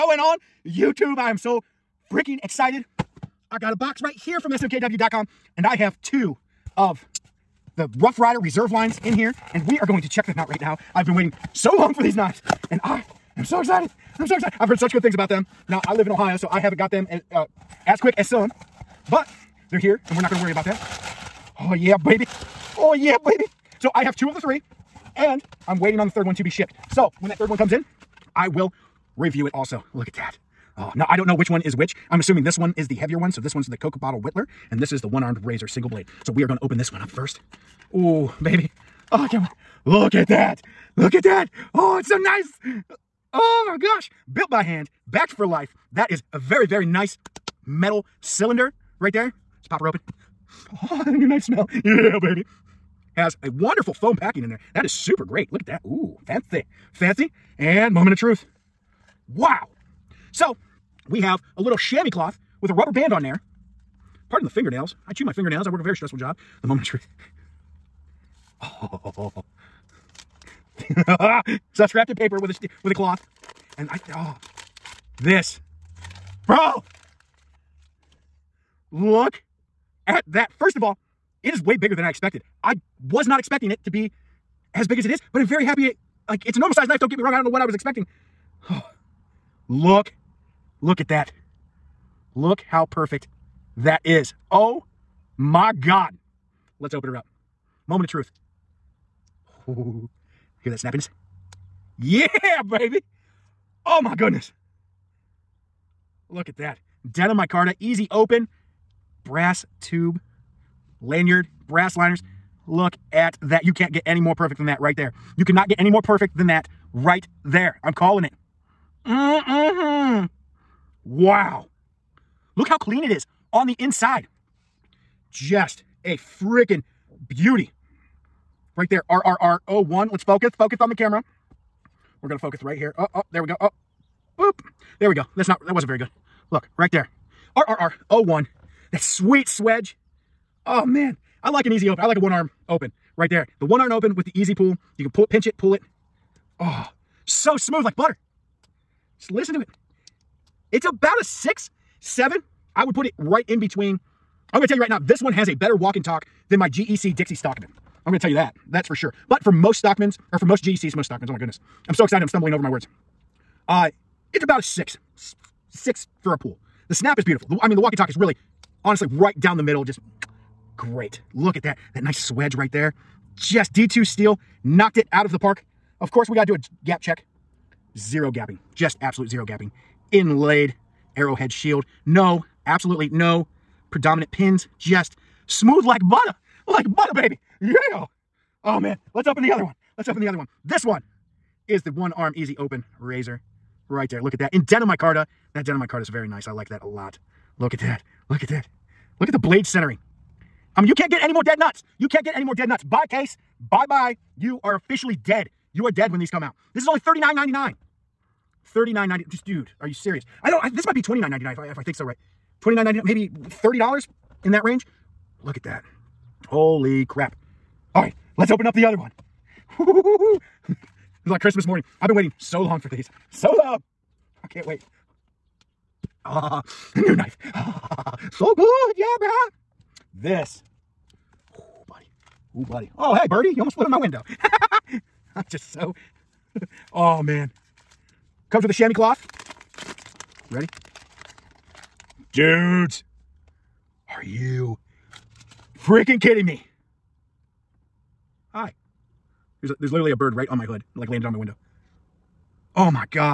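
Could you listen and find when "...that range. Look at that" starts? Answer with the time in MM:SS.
03:34.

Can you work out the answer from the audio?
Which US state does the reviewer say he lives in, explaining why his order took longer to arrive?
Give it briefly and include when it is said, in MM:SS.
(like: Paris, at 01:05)
Ohio, at 00:16.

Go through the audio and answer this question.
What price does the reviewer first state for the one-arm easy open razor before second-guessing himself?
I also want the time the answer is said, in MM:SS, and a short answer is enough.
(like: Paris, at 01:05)
$39.99, at 03:26.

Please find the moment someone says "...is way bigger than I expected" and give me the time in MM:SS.
01:21.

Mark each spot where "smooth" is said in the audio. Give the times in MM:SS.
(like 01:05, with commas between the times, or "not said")
02:27, 03:05.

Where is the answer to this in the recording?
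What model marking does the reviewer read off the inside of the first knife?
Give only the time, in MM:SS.
02:09.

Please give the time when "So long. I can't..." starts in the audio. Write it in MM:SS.
03:43.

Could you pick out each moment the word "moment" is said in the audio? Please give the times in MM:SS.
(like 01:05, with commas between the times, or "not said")
00:57, 01:06, 01:37.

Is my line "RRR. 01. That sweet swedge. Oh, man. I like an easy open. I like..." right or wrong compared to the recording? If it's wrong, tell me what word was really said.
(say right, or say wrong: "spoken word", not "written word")
right.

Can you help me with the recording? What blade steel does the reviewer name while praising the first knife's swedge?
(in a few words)
D2.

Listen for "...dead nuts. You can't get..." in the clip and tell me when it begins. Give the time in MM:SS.
03:21.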